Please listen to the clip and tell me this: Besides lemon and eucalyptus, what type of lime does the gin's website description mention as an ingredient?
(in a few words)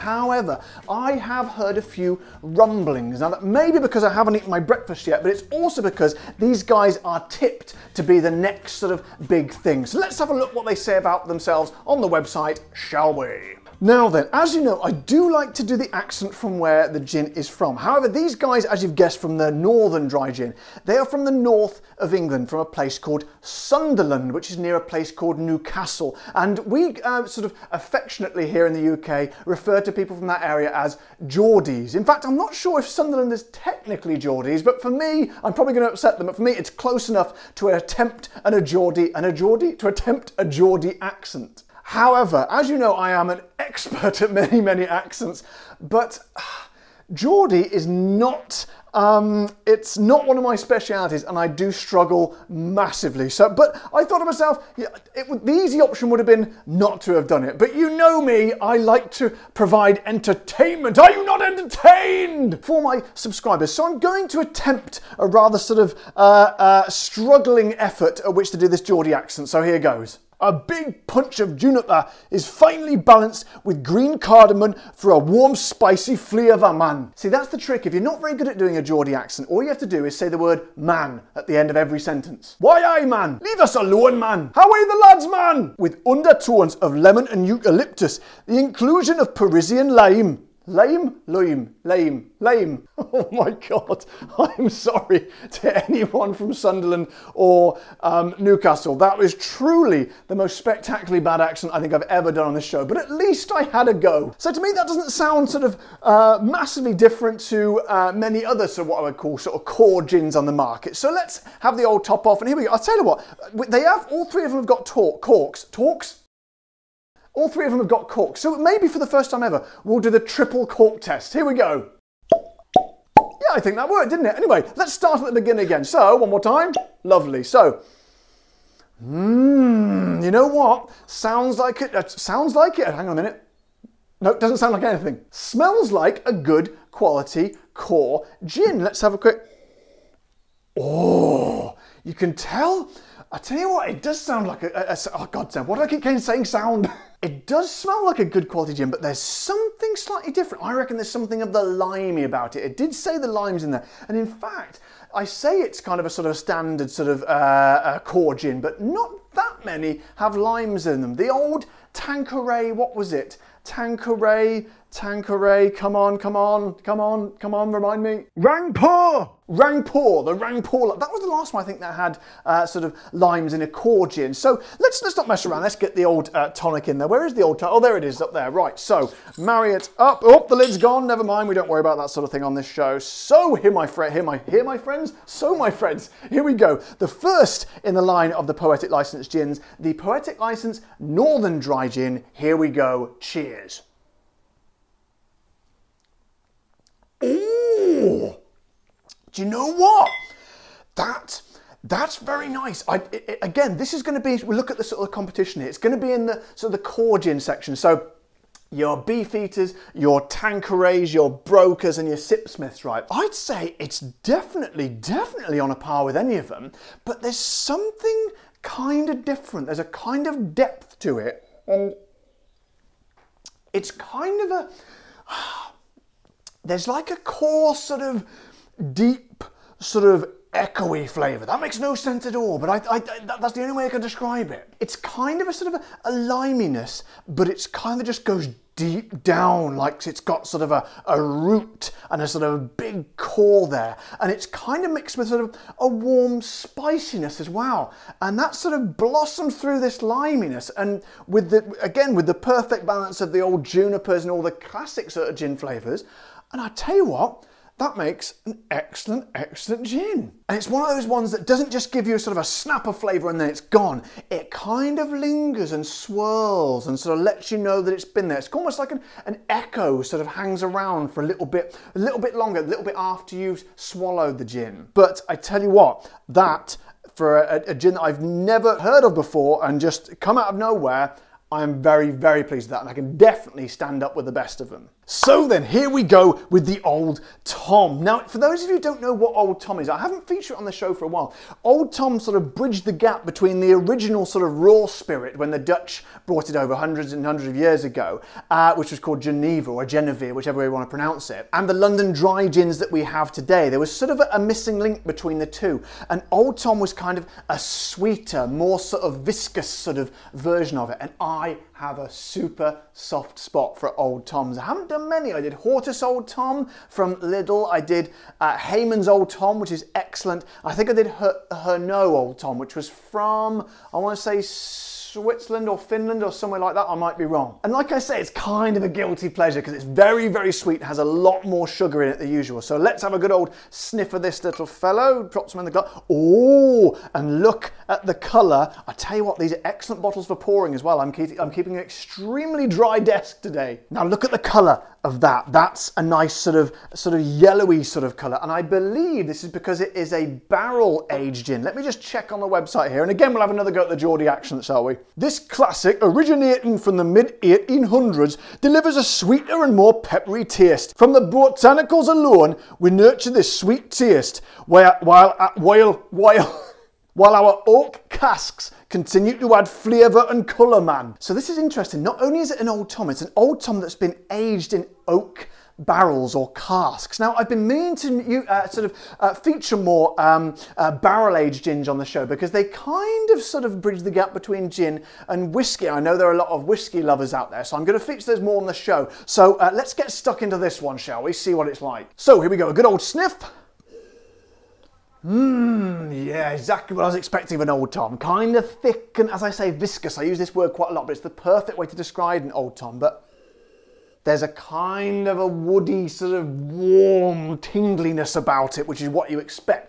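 Parisian lime.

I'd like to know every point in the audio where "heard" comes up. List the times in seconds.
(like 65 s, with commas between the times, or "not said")
1 s, 278 s.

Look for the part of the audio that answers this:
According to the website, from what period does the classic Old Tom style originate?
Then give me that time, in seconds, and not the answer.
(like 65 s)
357 s.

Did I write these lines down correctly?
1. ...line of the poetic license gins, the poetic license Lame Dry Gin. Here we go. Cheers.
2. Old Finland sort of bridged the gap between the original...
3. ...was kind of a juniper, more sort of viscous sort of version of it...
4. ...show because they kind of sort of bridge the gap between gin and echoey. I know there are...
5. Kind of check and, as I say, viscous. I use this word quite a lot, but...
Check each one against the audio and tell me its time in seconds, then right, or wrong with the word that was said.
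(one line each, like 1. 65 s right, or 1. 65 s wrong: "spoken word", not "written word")
1. 188 s wrong: "Northern", not "Lame"
2. 291 s wrong: "Tom", not "Finland"
3. 306 s wrong: "sweeter", not "juniper"
4. 382 s wrong: "whiskey", not "echoey"
5. 398 s wrong: "thick", not "check".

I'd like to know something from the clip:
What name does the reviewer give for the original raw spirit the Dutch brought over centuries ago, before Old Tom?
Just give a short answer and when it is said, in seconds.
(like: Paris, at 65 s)
Geneva, at 299 s.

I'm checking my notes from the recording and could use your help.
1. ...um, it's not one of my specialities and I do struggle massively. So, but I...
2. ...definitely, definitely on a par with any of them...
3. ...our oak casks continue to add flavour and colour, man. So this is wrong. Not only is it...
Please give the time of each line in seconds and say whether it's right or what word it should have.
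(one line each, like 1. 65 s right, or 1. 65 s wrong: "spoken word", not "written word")
1. 48 s right
2. 213 s right
3. 367 s wrong: "interesting", not "wrong".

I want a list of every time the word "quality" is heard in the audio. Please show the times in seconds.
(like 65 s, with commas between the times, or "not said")
136 s, 148 s.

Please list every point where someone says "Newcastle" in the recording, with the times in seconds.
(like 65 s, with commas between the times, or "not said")
25 s, 98 s.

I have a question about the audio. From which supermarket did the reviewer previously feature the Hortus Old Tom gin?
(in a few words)
Lidl.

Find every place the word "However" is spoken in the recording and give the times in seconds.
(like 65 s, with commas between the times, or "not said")
17 s, 41 s.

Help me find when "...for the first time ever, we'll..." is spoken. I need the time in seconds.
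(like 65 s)
118 s.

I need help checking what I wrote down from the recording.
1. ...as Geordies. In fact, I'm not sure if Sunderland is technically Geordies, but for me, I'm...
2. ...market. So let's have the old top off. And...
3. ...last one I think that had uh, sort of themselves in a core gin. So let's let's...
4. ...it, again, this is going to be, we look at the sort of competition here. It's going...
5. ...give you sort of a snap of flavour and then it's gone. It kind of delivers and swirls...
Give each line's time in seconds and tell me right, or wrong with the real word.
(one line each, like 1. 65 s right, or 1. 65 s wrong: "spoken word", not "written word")
1. 30 s right
2. 110 s right
3. 171 s wrong: "limes", not "themselves"
4. 203 s right
5. 261 s wrong: "lingers", not "delivers".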